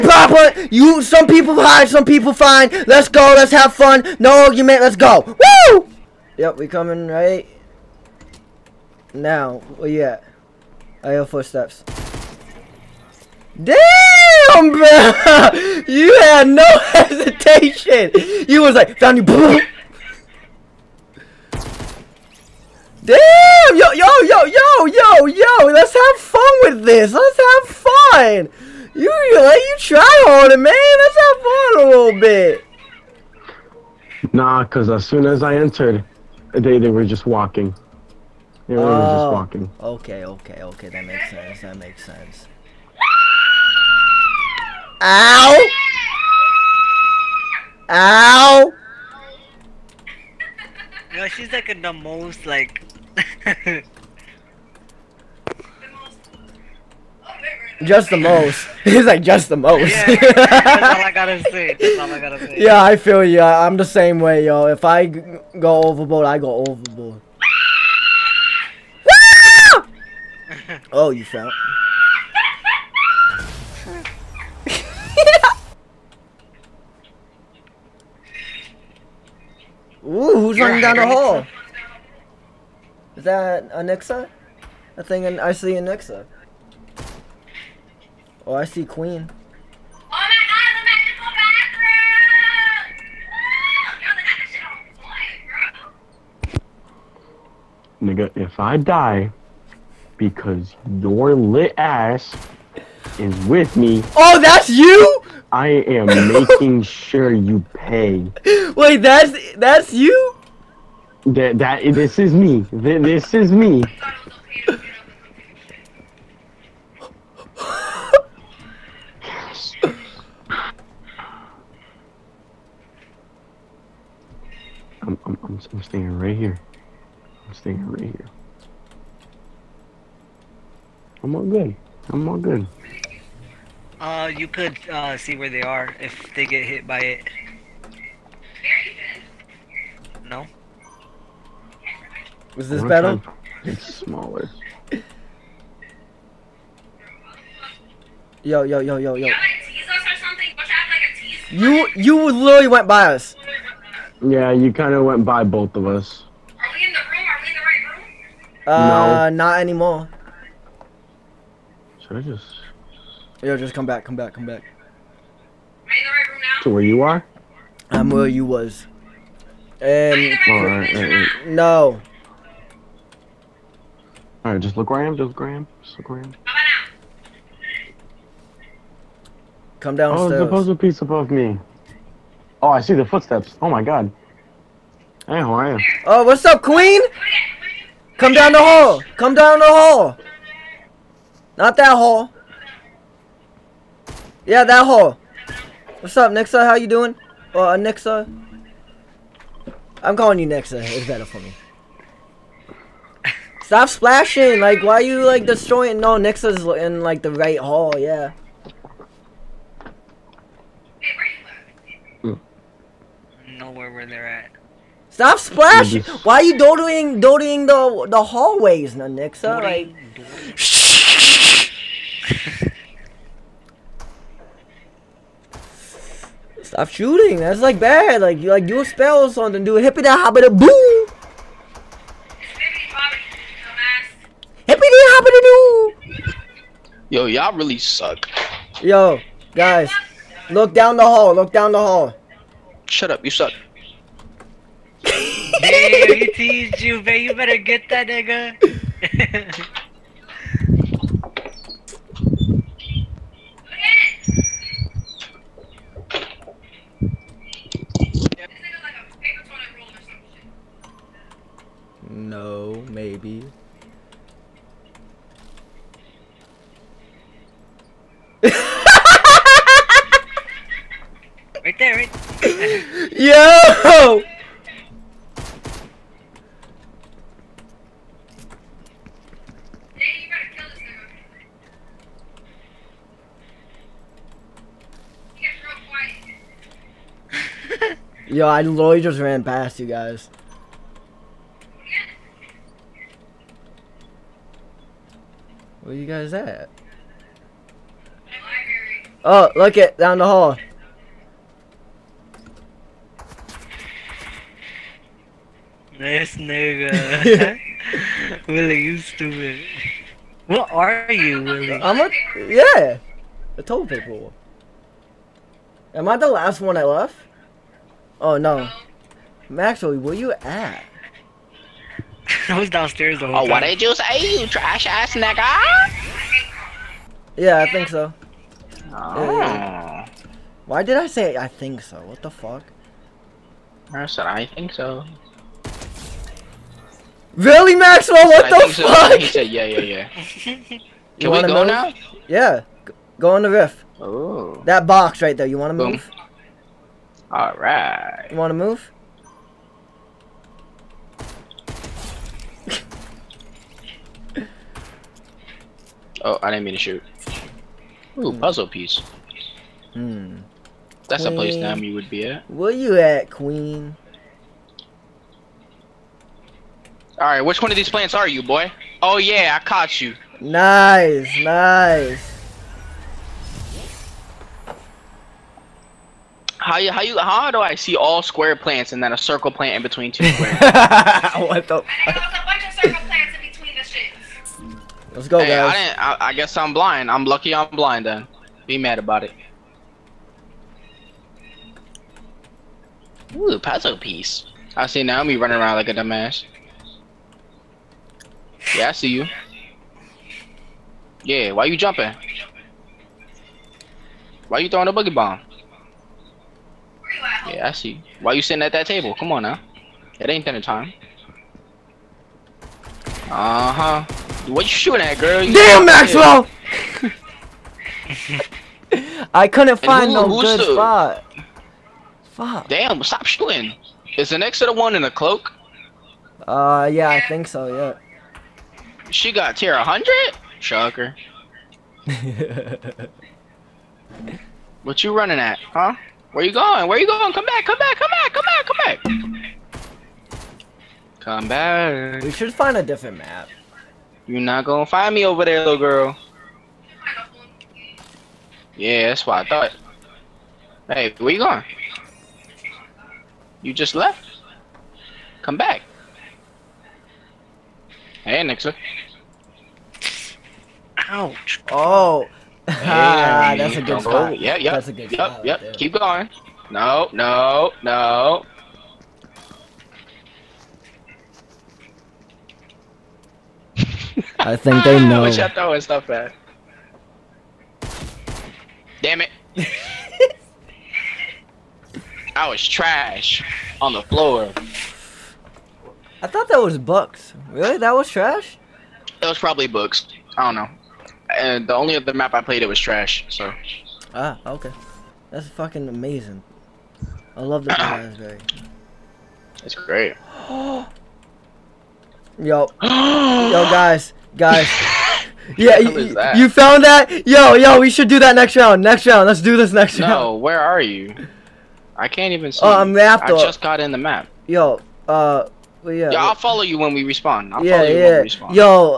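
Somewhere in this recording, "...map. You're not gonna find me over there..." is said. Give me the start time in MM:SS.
07:23.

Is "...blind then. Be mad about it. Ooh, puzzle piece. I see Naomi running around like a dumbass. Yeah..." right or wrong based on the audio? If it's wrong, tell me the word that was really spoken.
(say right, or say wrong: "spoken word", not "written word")
right.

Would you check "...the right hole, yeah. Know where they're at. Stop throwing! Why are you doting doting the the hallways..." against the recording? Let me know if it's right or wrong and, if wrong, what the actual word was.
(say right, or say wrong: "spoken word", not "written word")
wrong: "splashing", not "throwing".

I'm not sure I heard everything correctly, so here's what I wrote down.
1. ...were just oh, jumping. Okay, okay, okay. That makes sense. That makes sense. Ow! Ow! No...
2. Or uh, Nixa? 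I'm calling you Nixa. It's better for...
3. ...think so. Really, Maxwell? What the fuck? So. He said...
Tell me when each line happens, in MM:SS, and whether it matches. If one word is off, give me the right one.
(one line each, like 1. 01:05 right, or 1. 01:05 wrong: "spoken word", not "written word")
1. 00:38 wrong: "walking", not "jumping"
2. 03:17 right
3. 05:34 right.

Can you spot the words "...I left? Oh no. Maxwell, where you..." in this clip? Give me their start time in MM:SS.
05:16.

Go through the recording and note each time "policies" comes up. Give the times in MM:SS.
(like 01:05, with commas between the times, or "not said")
not said.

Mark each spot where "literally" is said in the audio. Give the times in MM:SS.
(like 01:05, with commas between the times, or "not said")
02:32, 04:48.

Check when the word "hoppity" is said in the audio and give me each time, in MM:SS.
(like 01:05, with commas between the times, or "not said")
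03:50, 03:55.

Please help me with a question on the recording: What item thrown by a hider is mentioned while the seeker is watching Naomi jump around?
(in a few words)
Boogie bomb.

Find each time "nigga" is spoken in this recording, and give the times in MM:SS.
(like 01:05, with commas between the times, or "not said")
01:38, 04:08, 05:06, 05:25.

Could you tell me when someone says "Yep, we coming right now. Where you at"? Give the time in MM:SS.
00:06.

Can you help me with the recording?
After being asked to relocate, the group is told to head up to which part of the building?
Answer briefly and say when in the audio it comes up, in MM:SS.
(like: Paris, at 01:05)
The roof, at 05:43.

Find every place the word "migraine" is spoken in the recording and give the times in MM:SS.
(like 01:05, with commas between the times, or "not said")
not said.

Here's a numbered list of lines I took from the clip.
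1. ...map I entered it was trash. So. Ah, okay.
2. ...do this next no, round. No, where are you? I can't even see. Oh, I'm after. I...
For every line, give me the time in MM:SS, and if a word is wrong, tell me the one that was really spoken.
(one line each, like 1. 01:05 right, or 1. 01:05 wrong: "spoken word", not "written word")
1. 08:12 wrong: "played", not "entered"
2. 08:29 right.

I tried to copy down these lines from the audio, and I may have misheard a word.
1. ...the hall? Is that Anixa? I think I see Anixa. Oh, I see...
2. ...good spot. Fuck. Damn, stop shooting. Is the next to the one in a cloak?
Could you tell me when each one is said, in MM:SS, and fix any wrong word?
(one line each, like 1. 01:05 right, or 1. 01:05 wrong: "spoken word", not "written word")
1. 01:20 right
2. 07:00 right.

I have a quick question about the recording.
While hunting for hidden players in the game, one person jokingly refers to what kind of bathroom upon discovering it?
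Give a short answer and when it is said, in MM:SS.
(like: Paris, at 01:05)
Magical bathroom, at 01:36.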